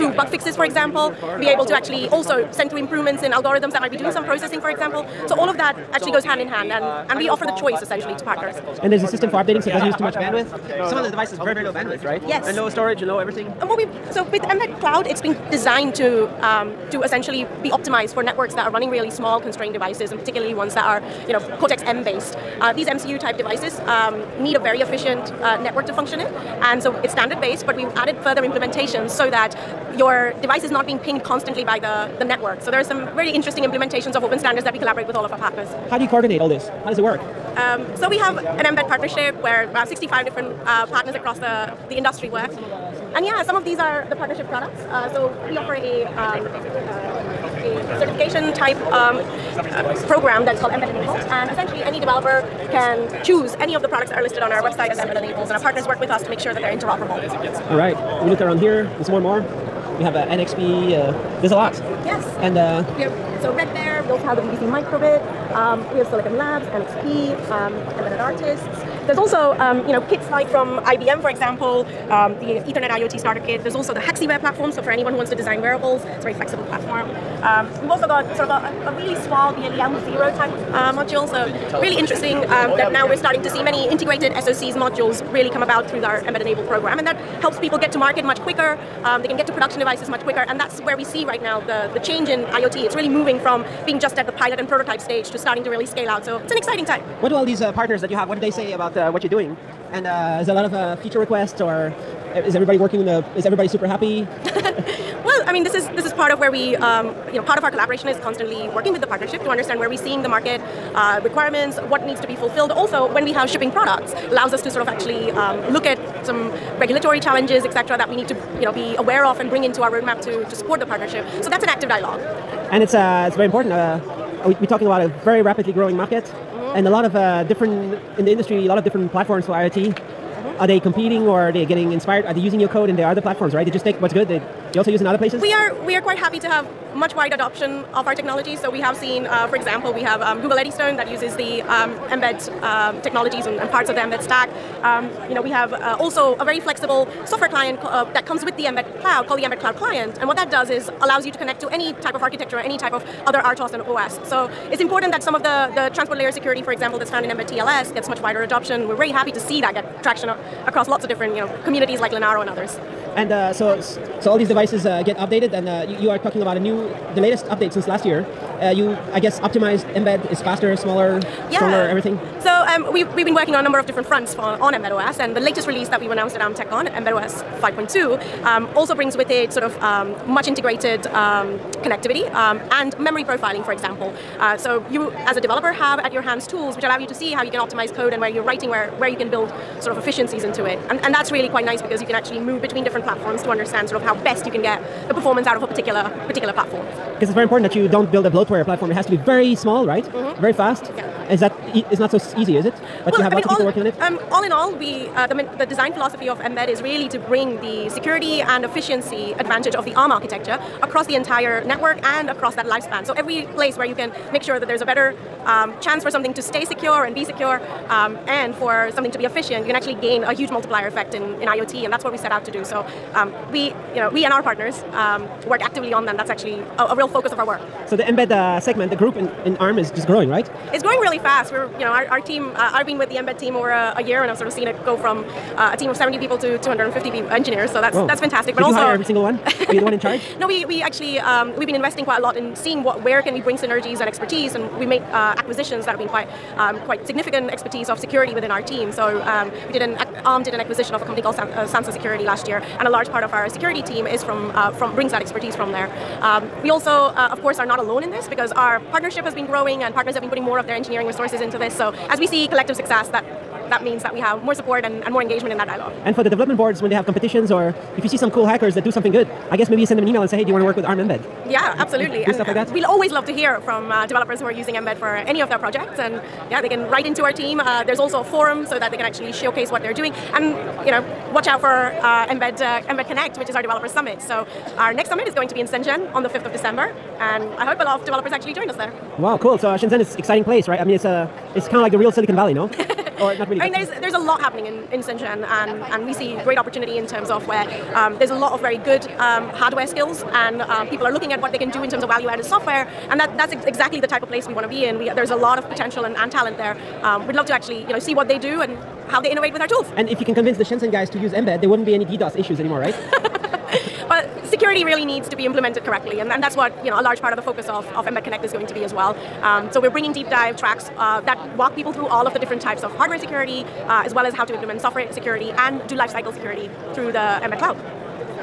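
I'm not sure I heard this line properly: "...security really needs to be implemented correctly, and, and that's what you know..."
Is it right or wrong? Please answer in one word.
right.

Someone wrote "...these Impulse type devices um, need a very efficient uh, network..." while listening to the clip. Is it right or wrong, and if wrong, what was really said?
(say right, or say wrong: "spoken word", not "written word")
wrong: "MCU", not "Impulse".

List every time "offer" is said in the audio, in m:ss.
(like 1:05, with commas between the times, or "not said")
0:07, 0:45.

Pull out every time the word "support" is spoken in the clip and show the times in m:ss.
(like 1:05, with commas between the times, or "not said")
2:00, 4:24.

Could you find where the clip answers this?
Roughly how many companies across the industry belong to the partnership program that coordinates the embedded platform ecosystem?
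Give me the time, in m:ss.
0:39.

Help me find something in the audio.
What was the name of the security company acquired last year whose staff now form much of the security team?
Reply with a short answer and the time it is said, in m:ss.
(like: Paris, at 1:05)
Sansa Security, at 4:11.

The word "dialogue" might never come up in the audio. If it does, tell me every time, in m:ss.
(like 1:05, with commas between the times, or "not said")
2:01, 4:25.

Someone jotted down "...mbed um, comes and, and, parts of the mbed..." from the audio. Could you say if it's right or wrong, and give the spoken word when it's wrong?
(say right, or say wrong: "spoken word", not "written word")
wrong: "technologies", not "comes".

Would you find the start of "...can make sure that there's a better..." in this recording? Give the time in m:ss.
3:33.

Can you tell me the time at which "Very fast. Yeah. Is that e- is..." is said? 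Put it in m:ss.
3:20.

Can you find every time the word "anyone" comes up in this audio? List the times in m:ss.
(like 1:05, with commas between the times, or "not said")
1:14.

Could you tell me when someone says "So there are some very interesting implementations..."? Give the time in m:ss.
0:32.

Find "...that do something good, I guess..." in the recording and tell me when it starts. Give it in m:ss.
4:28.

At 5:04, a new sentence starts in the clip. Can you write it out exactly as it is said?
We there's a lot of potential and, and talent there.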